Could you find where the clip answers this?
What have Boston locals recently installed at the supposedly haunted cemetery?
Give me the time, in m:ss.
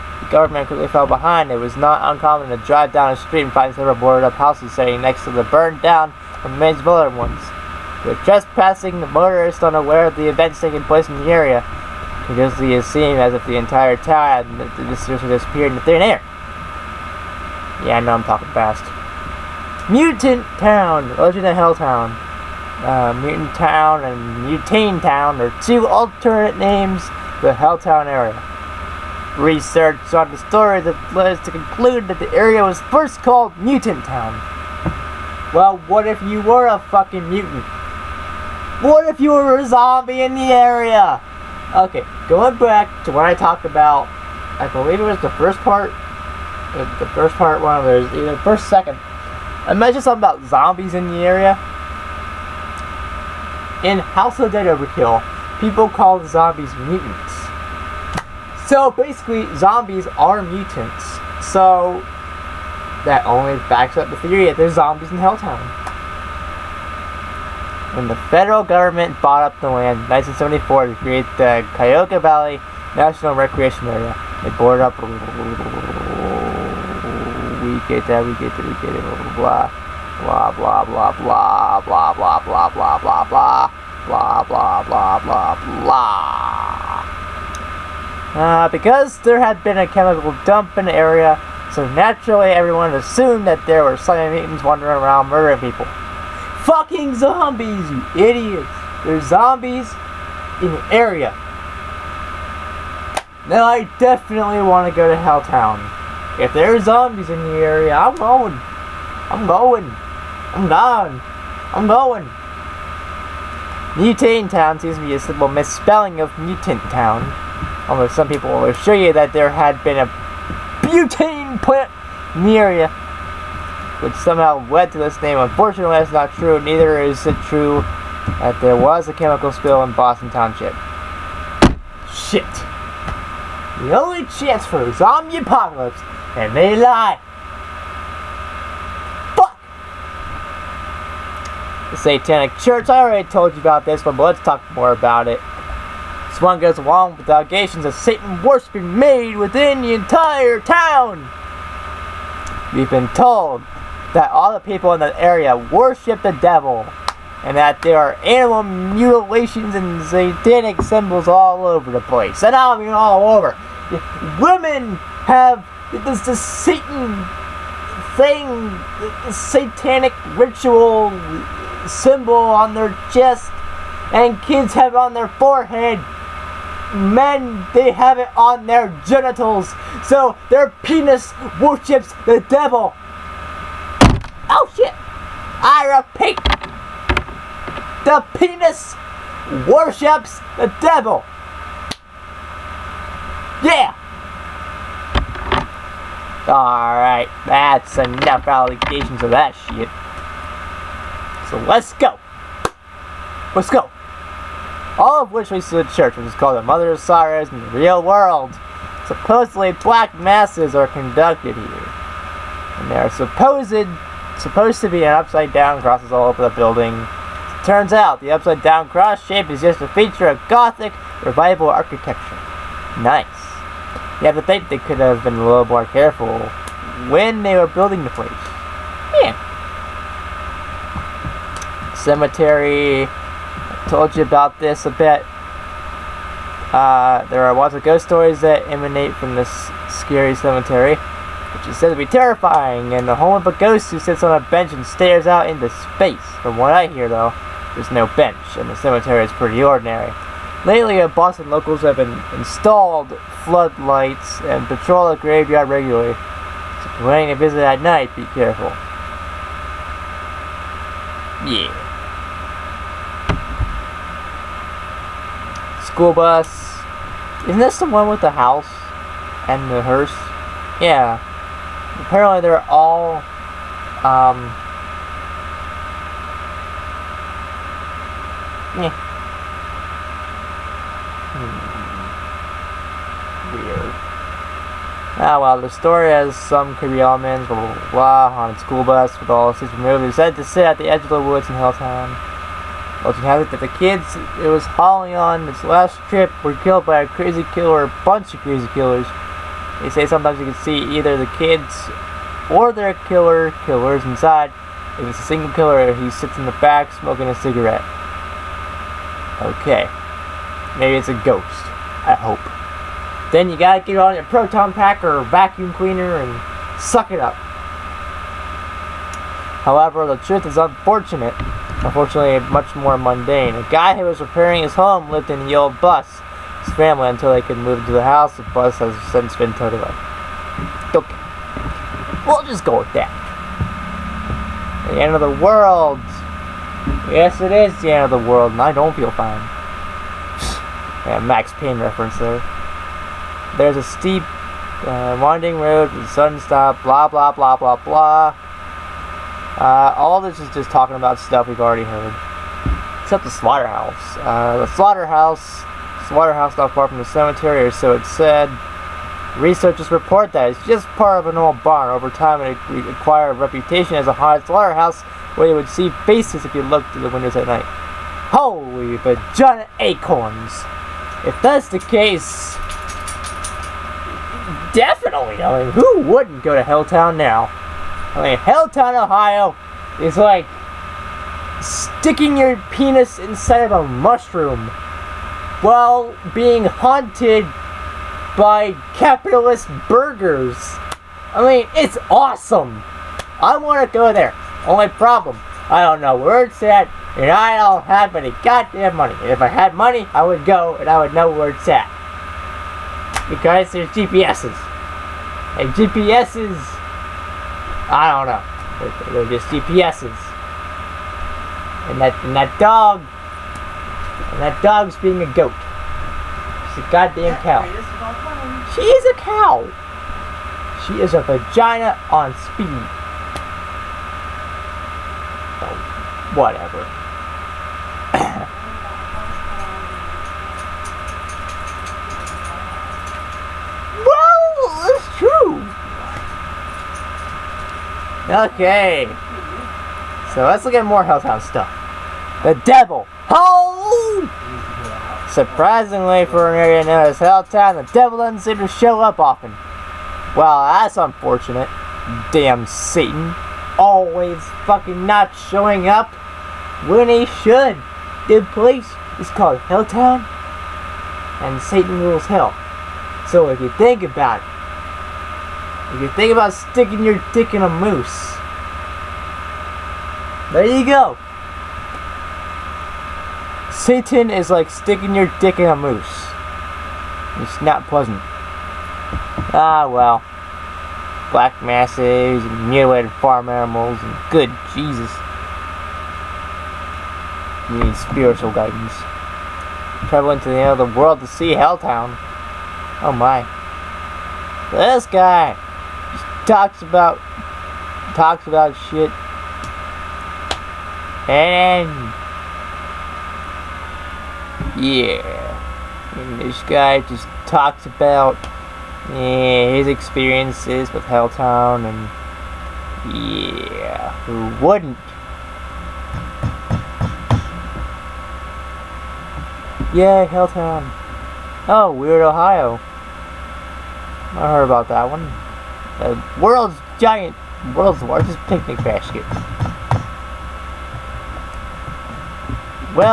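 4:13.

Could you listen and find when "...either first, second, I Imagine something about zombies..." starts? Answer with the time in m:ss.
0:48.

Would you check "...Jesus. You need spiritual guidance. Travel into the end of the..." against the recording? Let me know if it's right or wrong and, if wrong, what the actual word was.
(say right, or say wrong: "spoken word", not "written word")
right.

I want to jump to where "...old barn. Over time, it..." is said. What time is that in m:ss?
6:01.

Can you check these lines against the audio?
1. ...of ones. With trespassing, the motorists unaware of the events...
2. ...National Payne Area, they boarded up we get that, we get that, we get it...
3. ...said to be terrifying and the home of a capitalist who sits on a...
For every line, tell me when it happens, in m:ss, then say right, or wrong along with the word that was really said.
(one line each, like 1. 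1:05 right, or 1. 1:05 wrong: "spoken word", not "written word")
1. 0:06 right
2. 1:12 wrong: "Recreation", not "Payne"
3. 4:01 wrong: "ghost", not "capitalist".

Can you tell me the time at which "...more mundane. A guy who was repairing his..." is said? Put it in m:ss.
5:22.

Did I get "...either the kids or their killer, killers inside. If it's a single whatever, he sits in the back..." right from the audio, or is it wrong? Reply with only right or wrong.
wrong.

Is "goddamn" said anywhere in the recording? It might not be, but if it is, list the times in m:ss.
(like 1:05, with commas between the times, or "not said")
6:38, 6:56.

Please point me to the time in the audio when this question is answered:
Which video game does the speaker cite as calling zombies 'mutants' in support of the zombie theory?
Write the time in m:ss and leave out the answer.
0:53.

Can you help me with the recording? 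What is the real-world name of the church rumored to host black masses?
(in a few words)
Mother of Sorrows.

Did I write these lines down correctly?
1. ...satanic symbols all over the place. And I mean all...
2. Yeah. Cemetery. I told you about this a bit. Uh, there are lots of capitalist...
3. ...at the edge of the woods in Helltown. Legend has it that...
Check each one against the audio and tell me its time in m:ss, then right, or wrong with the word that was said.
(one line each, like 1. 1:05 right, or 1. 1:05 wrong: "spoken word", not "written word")
1. 2:40 right
2. 3:49 wrong: "ghost", not "capitalist"
3. 4:50 right.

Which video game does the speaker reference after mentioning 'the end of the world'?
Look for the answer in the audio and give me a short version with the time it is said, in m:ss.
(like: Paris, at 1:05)
Max Payne, at 5:41.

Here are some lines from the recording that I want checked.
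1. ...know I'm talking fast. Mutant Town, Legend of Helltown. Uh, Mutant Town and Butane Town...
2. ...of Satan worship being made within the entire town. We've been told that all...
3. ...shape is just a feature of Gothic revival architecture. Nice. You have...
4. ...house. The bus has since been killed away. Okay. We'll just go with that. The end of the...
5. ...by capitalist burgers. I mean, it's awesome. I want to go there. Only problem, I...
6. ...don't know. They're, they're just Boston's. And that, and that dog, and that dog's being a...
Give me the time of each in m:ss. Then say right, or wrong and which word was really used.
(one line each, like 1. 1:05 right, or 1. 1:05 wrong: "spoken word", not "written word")
1. 0:17 right
2. 2:27 right
3. 3:39 right
4. 5:28 wrong: "towed", not "killed"
5. 6:28 right
6. 6:48 wrong: "GPS", not "Boston".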